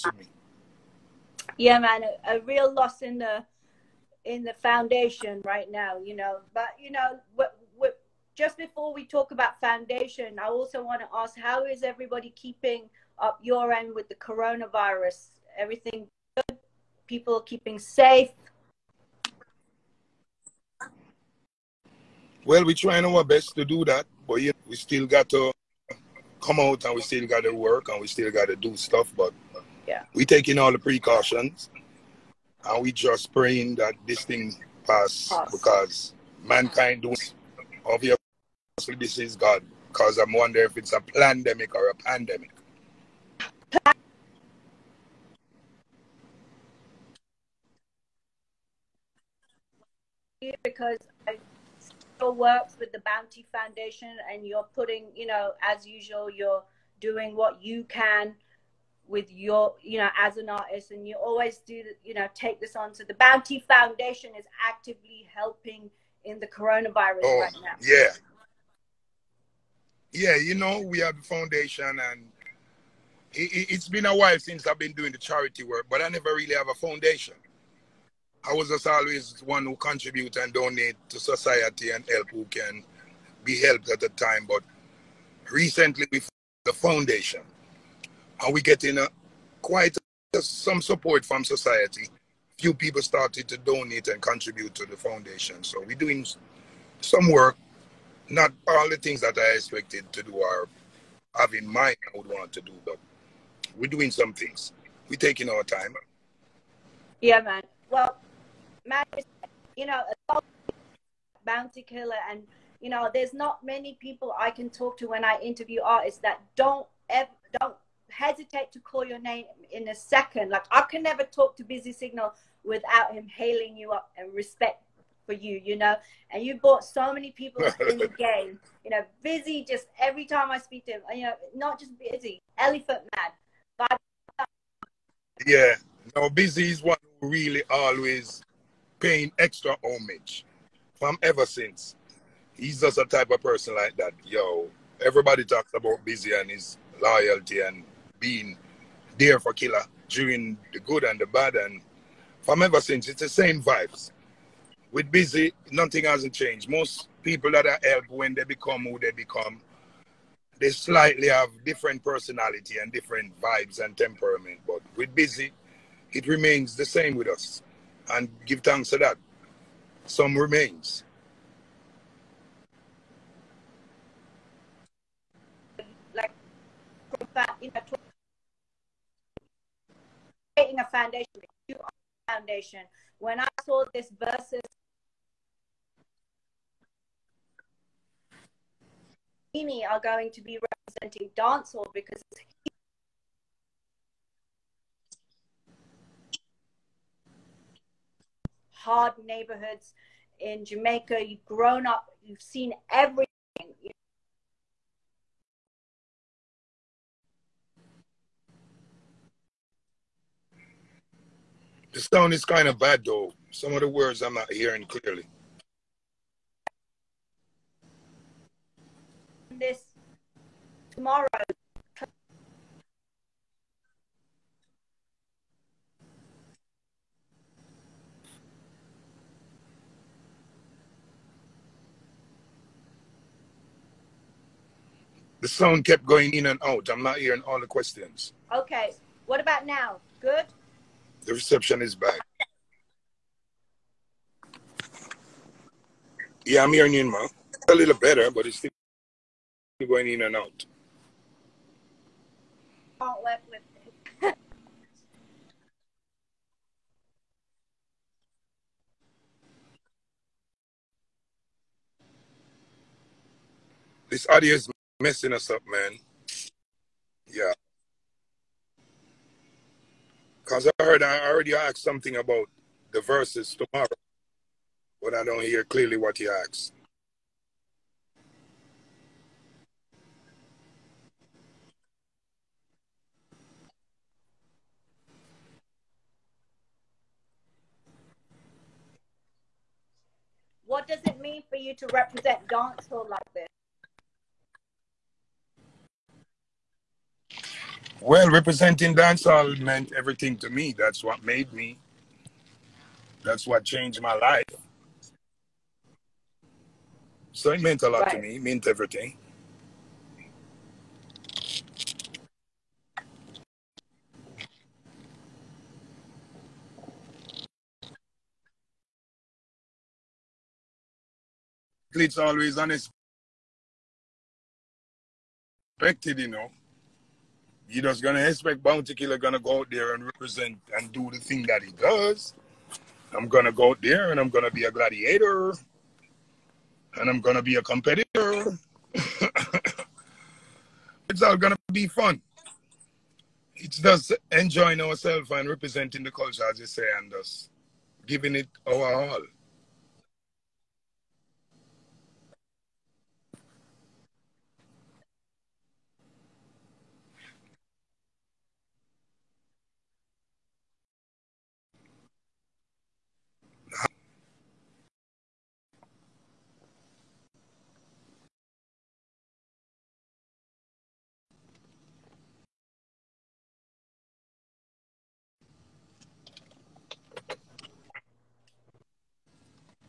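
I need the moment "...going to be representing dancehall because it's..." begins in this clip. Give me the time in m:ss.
3:10.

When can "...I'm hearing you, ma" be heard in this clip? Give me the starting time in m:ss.
4:06.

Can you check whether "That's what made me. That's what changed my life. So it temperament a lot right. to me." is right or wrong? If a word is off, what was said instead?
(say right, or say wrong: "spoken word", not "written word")
wrong: "meant", not "temperament".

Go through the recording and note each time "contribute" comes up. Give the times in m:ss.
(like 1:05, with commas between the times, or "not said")
1:19, 1:34.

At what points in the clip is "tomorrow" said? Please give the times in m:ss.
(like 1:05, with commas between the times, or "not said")
3:40, 4:33.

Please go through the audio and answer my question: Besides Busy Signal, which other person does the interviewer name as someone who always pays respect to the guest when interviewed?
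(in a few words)
Elephant Man.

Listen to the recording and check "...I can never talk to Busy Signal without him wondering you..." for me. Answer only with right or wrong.
wrong.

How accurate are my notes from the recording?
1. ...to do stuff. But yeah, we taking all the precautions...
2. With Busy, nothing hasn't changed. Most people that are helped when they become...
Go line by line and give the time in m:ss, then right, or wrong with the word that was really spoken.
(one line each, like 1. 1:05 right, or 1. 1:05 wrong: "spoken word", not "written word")
1. 0:28 right
2. 2:34 right.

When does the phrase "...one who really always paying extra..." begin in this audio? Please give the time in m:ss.
2:16.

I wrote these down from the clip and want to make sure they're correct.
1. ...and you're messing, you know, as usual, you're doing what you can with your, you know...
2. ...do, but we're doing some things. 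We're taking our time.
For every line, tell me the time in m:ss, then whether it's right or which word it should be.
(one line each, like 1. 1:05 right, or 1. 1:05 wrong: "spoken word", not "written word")
1. 0:54 wrong: "putting", not "messing"
2. 1:42 right.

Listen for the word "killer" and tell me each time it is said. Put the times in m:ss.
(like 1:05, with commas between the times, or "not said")
1:51, 2:29, 5:28.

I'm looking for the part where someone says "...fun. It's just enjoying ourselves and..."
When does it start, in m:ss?
5:41.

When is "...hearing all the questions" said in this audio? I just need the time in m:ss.
3:57.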